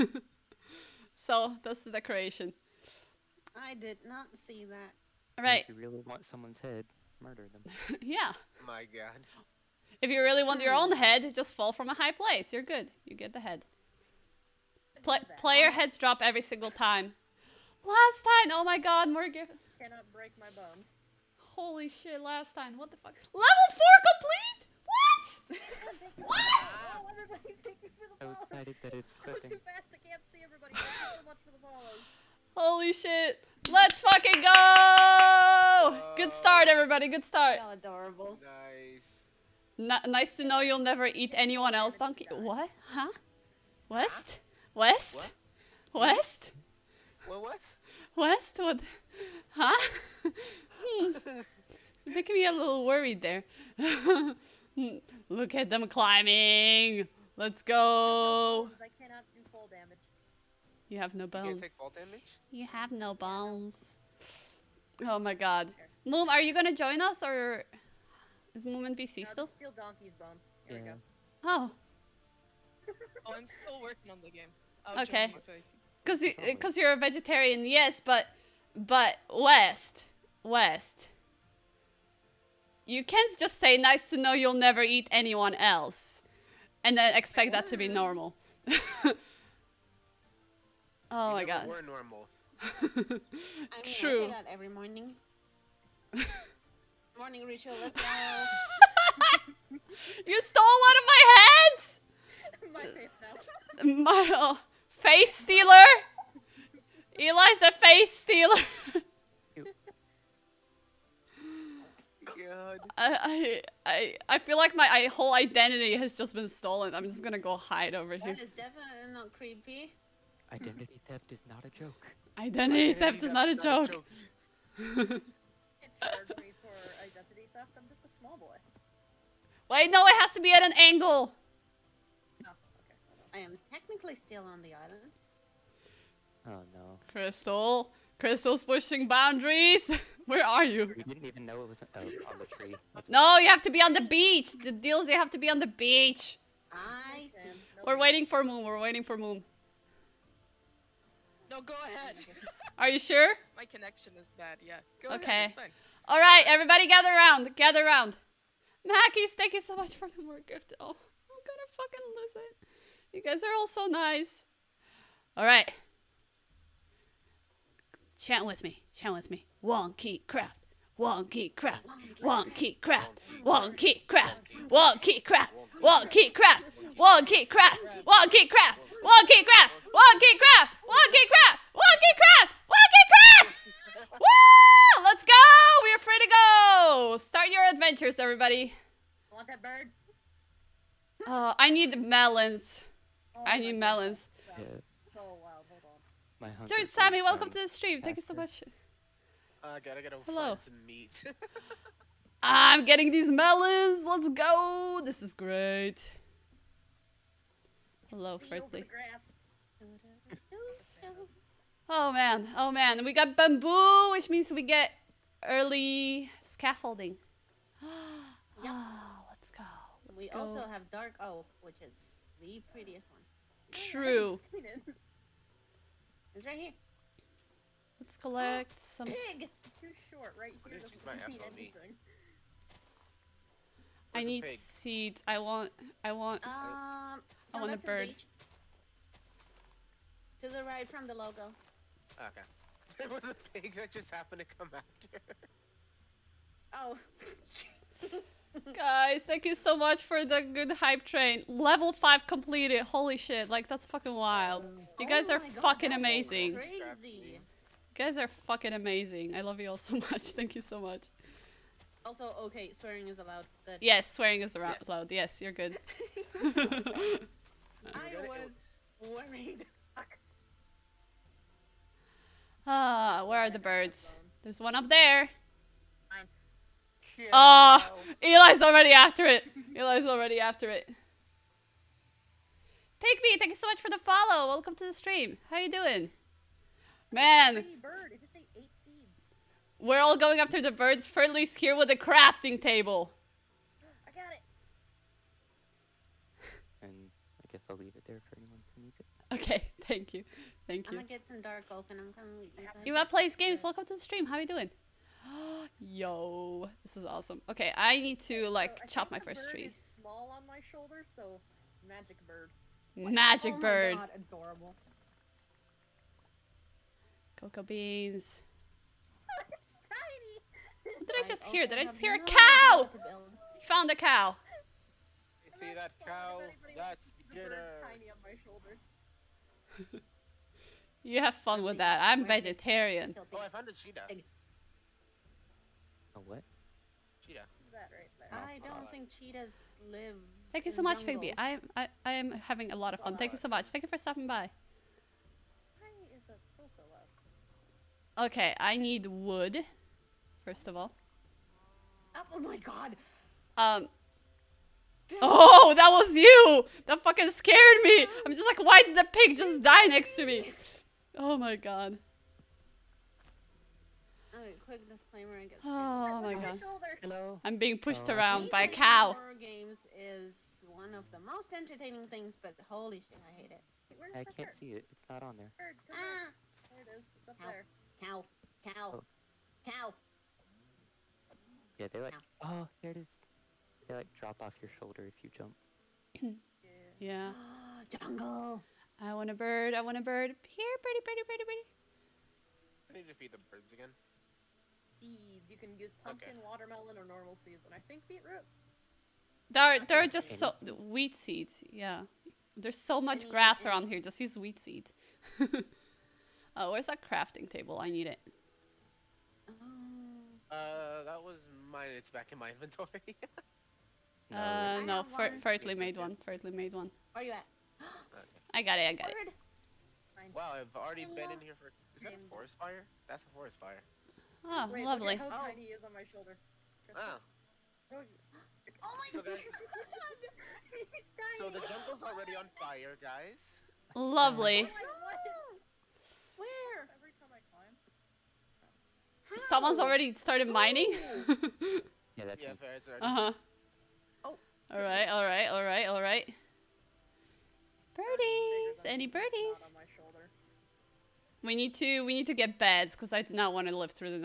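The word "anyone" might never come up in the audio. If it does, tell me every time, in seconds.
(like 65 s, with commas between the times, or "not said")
41 s, 85 s, 298 s.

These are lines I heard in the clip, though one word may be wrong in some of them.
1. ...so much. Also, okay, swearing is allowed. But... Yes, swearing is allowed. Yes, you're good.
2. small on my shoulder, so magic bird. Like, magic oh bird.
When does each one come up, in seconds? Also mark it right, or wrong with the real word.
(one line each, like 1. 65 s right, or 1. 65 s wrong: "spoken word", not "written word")
1. 260 s right
2. 309 s right.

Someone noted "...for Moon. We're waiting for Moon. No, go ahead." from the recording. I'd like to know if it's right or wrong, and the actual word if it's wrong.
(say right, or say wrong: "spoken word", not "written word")
right.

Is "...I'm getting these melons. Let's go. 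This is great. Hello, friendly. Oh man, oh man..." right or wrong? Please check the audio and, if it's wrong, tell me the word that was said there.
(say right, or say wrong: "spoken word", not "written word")
right.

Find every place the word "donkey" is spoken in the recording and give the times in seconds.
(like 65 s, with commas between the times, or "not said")
41 s, 69 s.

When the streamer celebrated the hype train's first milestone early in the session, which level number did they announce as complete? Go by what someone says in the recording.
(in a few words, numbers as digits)
4.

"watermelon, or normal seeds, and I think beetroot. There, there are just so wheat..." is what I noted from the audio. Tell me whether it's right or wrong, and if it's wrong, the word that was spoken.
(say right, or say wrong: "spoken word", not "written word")
right.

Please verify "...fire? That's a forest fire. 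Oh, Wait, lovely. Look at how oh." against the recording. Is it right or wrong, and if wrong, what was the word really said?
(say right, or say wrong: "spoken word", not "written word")
right.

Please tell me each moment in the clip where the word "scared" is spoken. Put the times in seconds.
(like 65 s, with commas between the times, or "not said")
357 s.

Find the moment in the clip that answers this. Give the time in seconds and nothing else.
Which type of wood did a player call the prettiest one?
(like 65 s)
220 s.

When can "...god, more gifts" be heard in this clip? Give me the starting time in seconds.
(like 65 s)
18 s.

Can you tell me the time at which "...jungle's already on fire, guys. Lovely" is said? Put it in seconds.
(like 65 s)
431 s.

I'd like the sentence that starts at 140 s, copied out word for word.
You didn't even know it was oh, on the tree.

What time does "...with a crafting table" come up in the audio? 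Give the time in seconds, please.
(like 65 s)
291 s.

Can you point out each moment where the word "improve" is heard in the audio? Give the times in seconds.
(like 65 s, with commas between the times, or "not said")
not said.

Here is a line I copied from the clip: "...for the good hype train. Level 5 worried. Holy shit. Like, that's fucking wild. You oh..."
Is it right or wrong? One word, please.
wrong.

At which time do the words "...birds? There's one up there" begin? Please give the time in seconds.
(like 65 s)
273 s.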